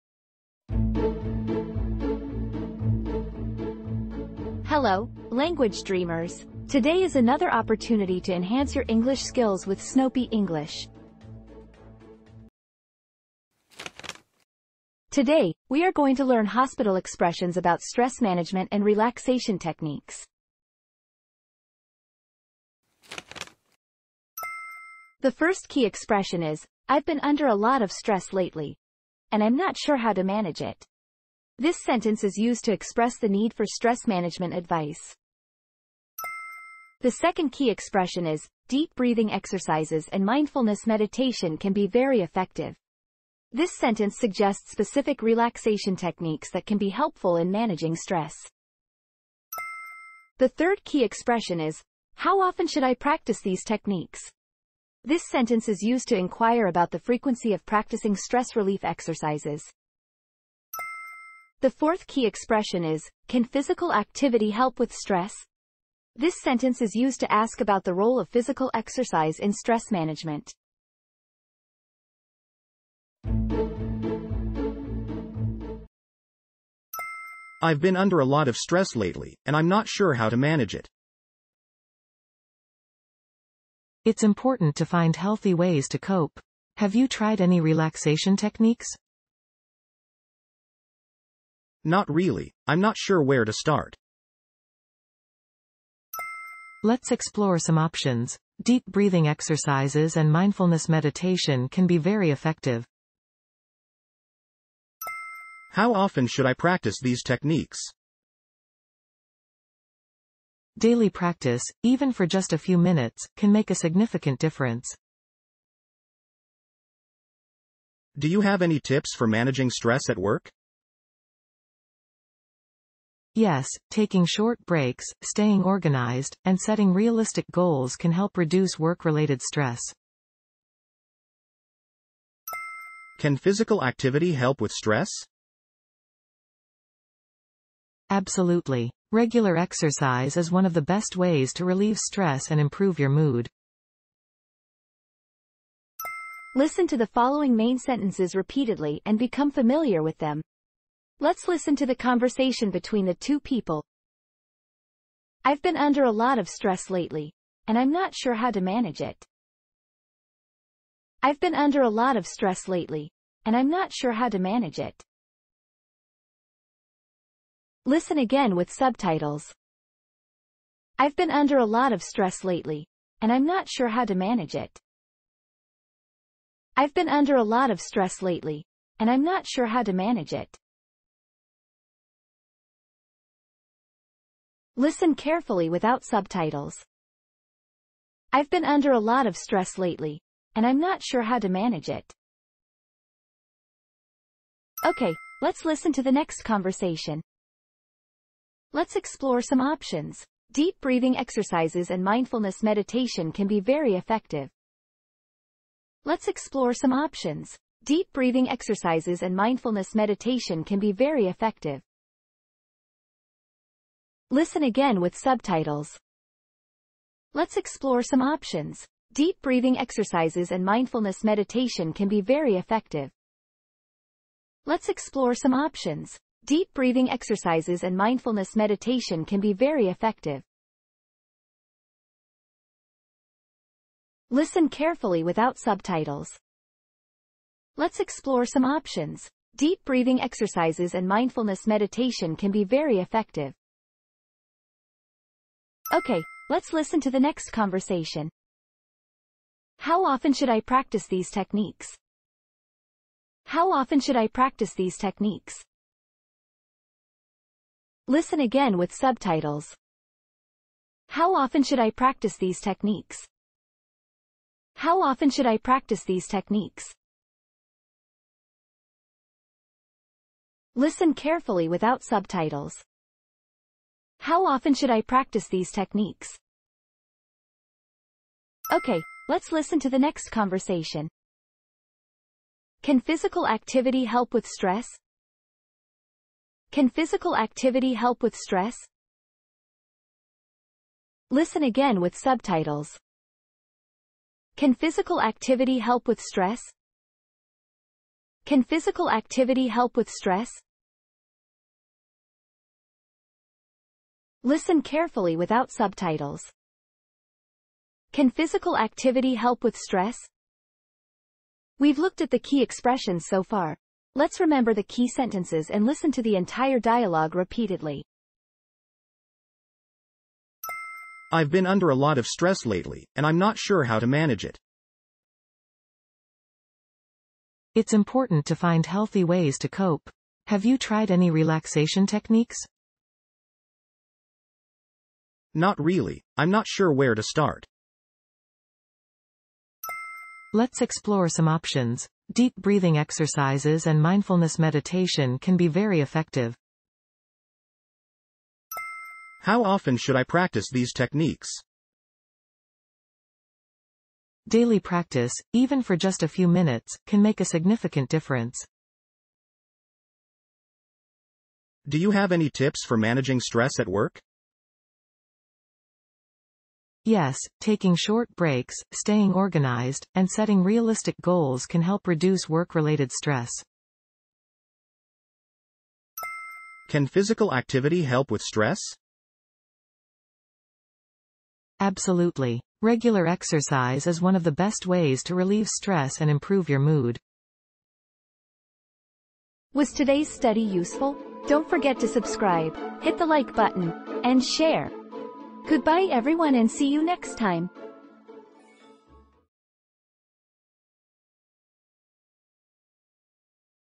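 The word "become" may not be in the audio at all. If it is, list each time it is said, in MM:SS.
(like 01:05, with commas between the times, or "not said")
02:29.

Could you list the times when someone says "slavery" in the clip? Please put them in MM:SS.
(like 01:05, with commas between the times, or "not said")
not said.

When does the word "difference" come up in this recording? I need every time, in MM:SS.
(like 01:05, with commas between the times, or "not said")
01:54, 05:58.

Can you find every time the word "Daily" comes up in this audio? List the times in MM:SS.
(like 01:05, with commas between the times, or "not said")
01:50, 05:54.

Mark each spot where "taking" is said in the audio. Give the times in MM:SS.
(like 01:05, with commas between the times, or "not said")
02:03, 06:07.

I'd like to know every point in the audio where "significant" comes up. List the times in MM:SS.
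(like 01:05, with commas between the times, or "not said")
01:53, 05:57.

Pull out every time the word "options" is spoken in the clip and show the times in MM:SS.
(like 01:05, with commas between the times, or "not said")
01:37, 03:19, 03:26, 03:38, 03:45, 03:58, 05:41.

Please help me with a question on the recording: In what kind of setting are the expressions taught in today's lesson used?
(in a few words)
hospital.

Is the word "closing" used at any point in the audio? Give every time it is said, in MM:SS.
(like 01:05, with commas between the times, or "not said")
not said.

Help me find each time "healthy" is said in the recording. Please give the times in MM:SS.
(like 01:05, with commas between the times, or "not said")
01:25, 05:28.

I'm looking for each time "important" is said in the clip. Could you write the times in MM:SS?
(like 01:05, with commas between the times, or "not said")
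01:24, 05:27.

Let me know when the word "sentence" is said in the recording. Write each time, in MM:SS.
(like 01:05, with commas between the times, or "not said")
00:31, 00:43, 00:55, 01:06, 02:27, 05:15.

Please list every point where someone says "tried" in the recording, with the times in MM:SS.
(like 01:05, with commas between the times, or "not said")
01:27, 05:30.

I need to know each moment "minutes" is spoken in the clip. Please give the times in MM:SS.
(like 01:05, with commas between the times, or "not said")
01:52, 05:56.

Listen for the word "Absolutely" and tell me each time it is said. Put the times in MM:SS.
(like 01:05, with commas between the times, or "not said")
02:18, 06:21.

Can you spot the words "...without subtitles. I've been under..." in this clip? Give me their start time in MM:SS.
03:05.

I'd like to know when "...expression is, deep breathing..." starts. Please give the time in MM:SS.
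00:37.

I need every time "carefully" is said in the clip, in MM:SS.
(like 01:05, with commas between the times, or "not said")
03:05, 03:54, 04:31, 05:04.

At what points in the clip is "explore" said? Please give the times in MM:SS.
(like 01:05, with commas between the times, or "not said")
01:37, 03:18, 03:26, 03:37, 03:44, 03:57, 05:40.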